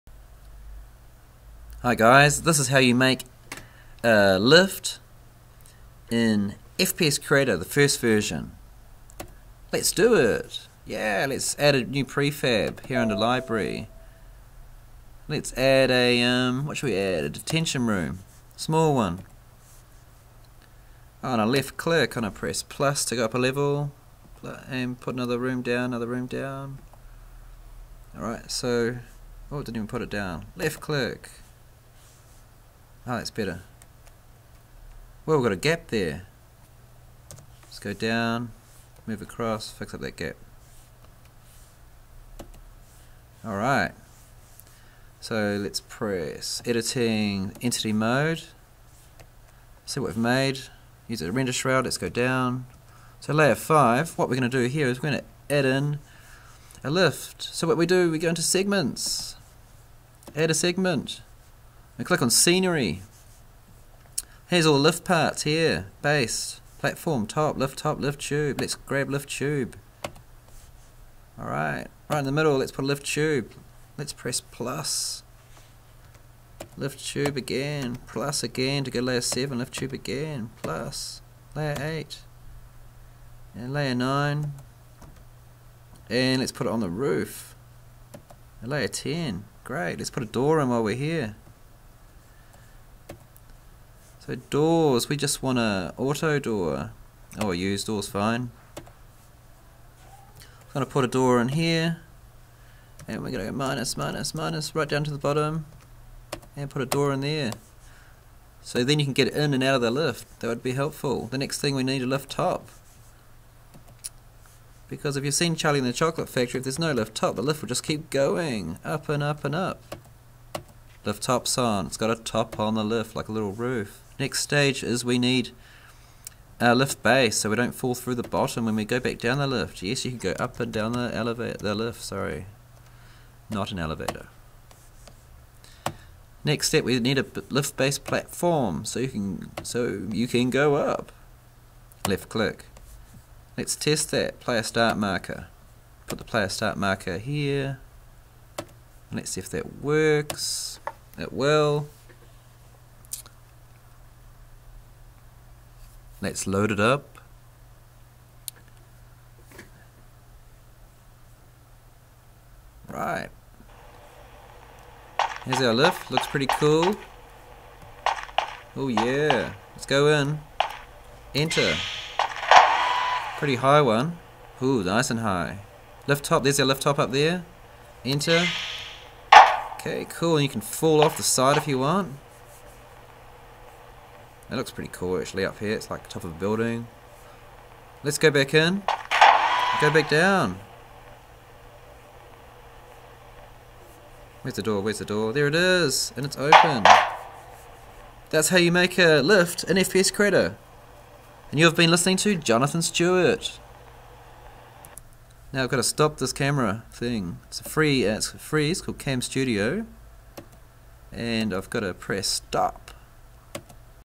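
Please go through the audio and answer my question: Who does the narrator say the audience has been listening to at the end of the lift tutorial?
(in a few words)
Jonathan Stewart.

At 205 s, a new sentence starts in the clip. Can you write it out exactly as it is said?
Now I've got to stop this camera thing.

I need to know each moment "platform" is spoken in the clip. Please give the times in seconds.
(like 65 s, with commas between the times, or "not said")
66 s, 137 s.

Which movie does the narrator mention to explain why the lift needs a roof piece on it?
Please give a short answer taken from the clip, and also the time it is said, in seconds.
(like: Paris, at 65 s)
Charlie in the Chocolate Factory, at 115 s.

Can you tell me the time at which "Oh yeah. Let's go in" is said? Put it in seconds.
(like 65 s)
168 s.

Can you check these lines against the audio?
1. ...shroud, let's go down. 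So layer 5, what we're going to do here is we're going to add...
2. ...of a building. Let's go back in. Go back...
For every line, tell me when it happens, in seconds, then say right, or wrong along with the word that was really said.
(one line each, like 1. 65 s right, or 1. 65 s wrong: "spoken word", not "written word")
1. 51 s right
2. 186 s right.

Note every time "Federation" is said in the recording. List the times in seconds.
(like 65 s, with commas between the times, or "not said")
not said.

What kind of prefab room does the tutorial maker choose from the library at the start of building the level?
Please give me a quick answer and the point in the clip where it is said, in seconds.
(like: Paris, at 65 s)
Detention room, at 17 s.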